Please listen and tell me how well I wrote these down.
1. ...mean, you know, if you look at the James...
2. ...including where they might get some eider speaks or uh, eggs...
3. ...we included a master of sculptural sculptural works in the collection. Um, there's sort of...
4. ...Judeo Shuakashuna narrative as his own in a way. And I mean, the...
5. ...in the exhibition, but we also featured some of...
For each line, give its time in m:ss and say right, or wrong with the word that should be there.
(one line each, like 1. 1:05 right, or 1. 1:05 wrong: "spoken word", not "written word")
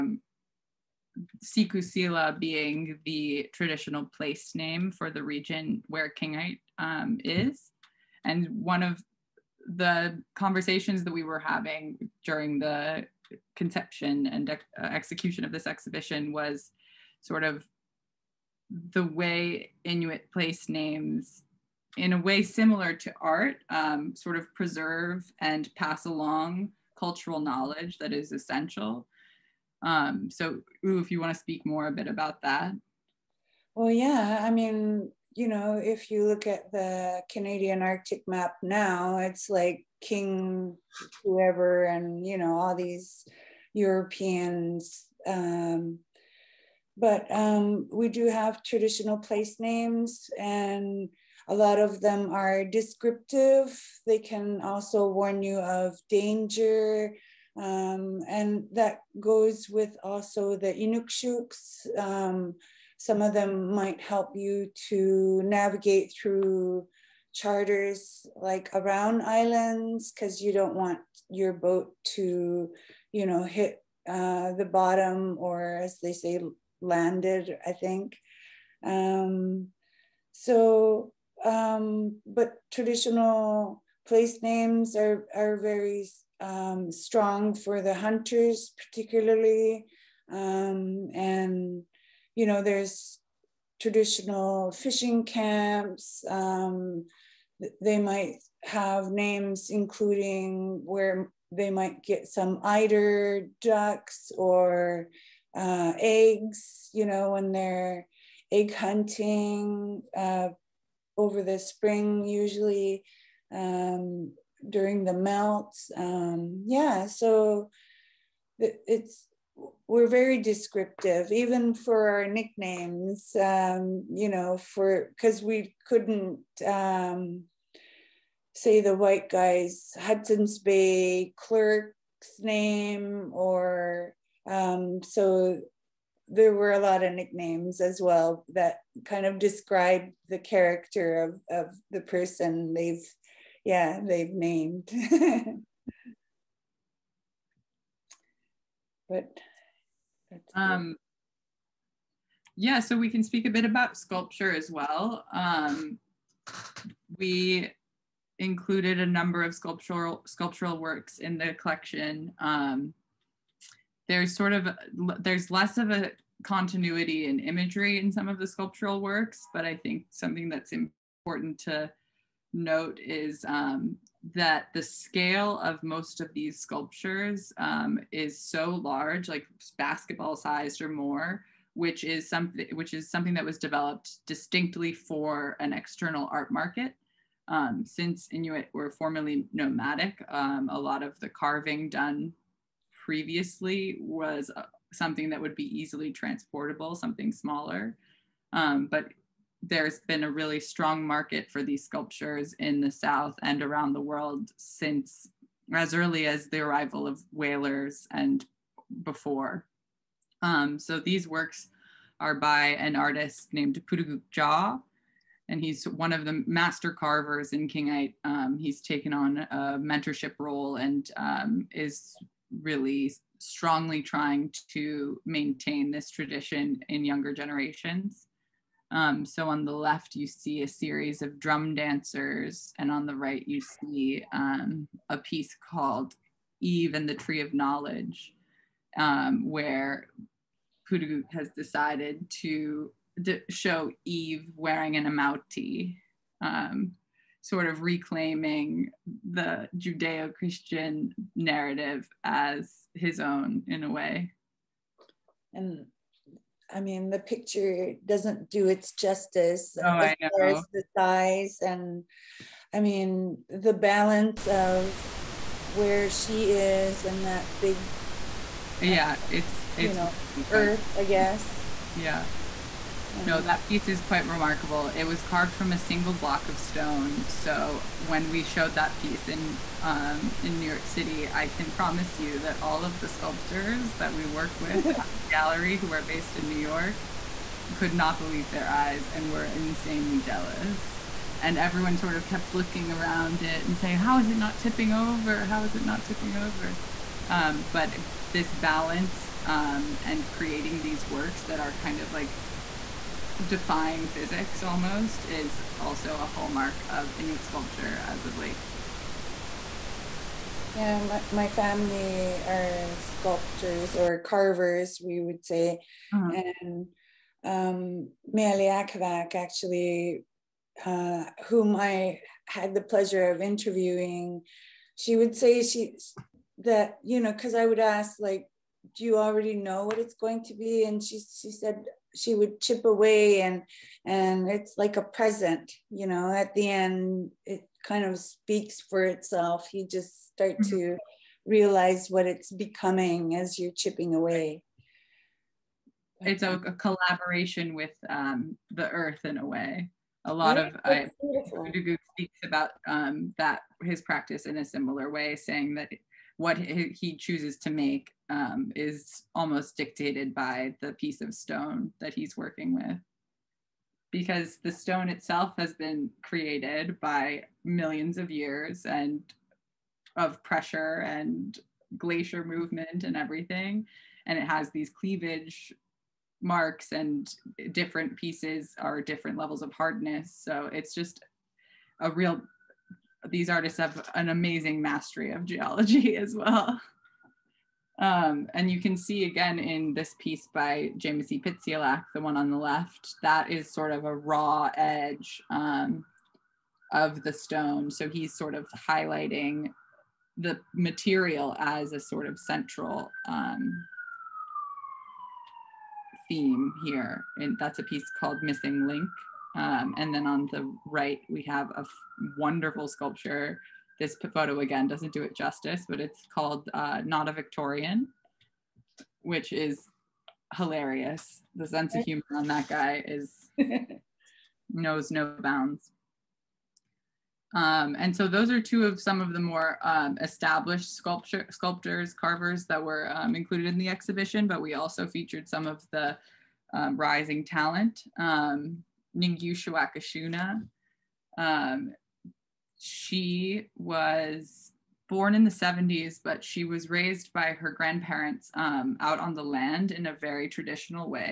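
1. 0:34 wrong: "Canadian", not "James"
2. 1:39 wrong: "ducks", not "speaks"
3. 2:37 wrong: "number", not "master"
4. 4:09 wrong: "Christian", not "Shuakashuna"
5. 7:13 right.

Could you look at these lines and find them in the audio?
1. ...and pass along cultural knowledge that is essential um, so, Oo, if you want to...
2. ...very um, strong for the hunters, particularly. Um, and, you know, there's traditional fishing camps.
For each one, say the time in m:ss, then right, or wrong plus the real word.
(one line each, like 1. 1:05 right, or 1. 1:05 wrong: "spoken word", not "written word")
1. 0:25 right
2. 1:25 right.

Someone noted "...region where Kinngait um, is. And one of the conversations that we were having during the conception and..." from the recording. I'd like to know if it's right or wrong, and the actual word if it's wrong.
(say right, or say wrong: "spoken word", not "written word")
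right.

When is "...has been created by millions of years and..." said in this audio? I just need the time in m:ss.
6:05.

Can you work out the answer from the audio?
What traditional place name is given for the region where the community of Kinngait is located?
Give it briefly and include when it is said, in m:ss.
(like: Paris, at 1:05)
Sikusila, at 0:01.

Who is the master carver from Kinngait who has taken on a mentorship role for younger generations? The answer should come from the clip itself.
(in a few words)
Pootoogook Jaw.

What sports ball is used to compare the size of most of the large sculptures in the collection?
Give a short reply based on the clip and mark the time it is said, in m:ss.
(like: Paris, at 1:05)
Basketball, at 2:59.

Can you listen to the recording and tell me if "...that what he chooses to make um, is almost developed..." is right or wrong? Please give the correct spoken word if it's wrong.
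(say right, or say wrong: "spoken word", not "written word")
wrong: "dictated", not "developed".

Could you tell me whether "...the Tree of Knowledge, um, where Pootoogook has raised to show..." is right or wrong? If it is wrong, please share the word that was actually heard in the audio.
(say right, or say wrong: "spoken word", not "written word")
wrong: "decided", not "raised".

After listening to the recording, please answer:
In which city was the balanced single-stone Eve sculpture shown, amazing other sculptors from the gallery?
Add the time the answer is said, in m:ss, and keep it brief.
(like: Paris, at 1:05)
New York City, at 4:40.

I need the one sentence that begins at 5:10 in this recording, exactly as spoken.
Yeah, my, my family are sculptors or carvers, we would say.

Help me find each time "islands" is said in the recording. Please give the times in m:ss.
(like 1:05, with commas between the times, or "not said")
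1:09.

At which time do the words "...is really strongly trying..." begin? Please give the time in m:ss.
3:41.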